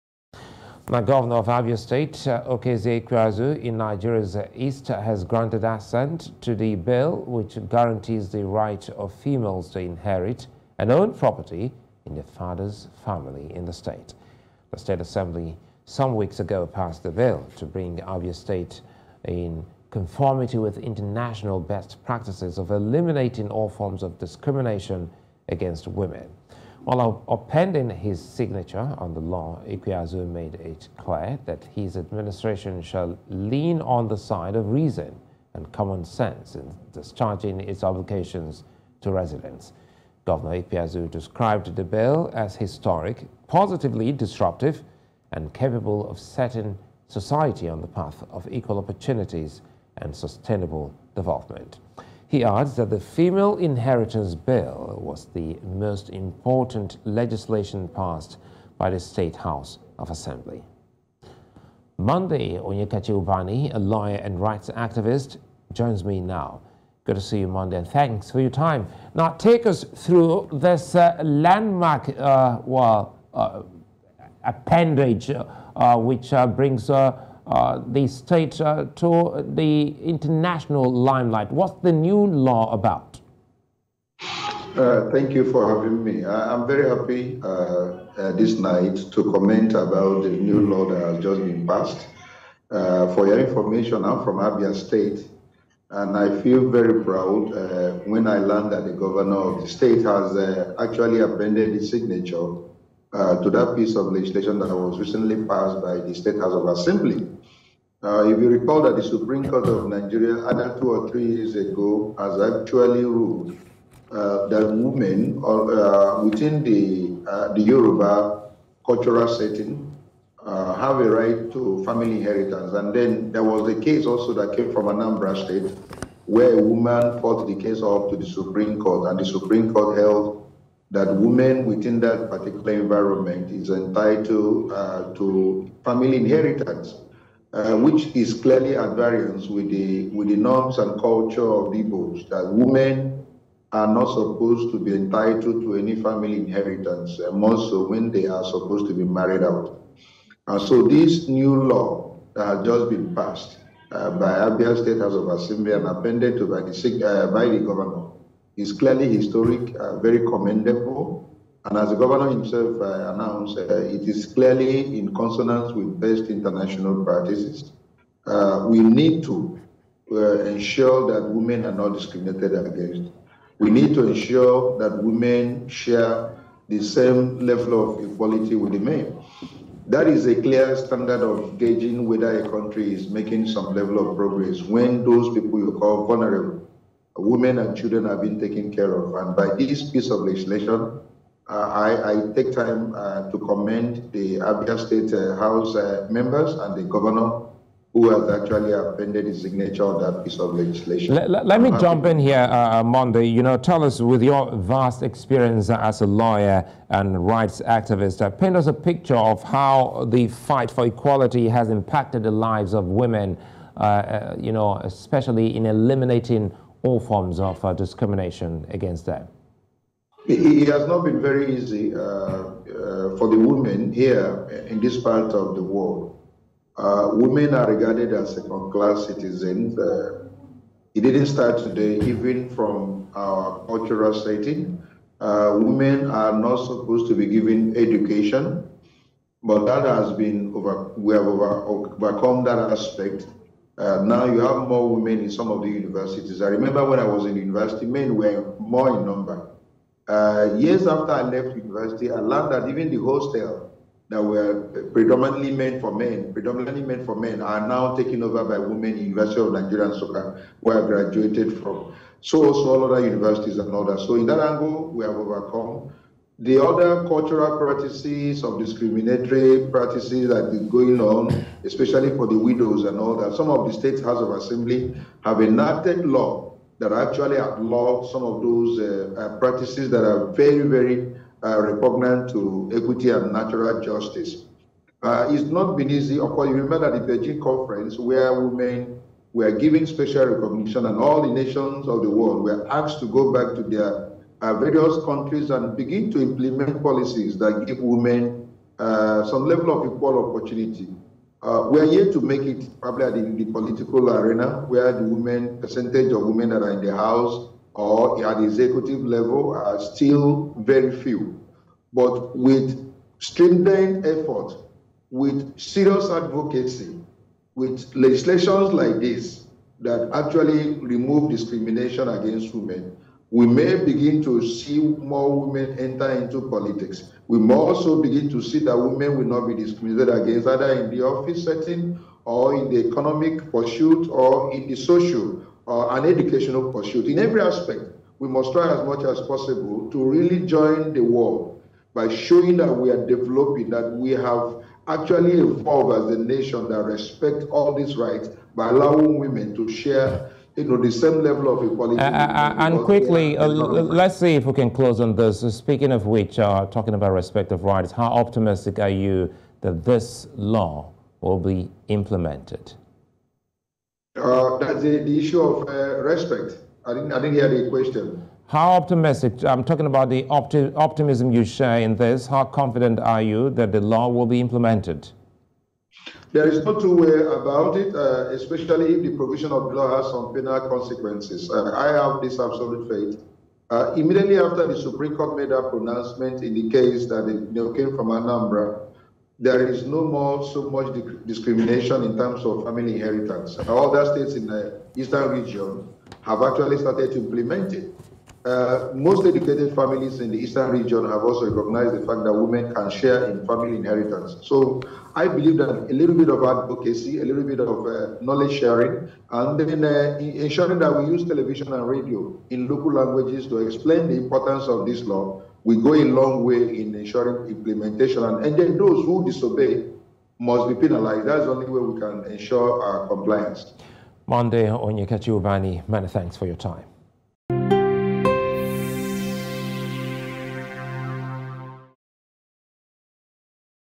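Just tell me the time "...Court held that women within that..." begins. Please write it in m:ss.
2:09.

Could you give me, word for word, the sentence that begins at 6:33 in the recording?
All the states in the eastern region have actually started to implement it.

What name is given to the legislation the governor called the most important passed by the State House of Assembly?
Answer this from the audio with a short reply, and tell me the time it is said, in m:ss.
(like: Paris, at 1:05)
Female Inheritance Bill, at 0:52.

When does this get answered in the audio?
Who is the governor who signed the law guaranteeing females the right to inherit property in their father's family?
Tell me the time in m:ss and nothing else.
0:02.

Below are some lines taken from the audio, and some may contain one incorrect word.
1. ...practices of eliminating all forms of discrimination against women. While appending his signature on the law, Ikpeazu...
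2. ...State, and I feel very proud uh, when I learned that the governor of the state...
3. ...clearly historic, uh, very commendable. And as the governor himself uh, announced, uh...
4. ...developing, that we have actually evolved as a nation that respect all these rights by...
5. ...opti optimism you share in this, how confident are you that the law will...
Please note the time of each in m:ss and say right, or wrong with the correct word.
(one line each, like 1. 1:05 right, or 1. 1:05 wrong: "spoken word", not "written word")
1. 0:22 right
2. 1:34 right
3. 2:38 right
4. 5:43 right
5. 6:10 right.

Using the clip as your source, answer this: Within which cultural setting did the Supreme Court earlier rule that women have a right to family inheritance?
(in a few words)
Yoruba.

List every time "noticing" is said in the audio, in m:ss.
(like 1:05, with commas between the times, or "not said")
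not said.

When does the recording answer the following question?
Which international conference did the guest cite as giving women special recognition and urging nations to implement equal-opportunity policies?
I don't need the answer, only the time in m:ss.
4:47.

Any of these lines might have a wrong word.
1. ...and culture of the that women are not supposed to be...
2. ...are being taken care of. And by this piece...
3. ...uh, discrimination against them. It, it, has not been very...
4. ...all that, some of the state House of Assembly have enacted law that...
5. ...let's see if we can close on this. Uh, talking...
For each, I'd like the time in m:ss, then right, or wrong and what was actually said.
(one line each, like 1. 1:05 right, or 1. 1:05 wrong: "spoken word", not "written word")
1. 2:20 right
2. 3:08 right
3. 3:37 right
4. 4:32 right
5. 5:53 wrong: "speaking", not "talking".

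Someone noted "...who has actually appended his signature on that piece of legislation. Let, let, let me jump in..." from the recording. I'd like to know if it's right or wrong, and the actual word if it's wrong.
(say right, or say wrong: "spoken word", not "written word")
right.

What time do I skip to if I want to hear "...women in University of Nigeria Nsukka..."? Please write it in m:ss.
4:18.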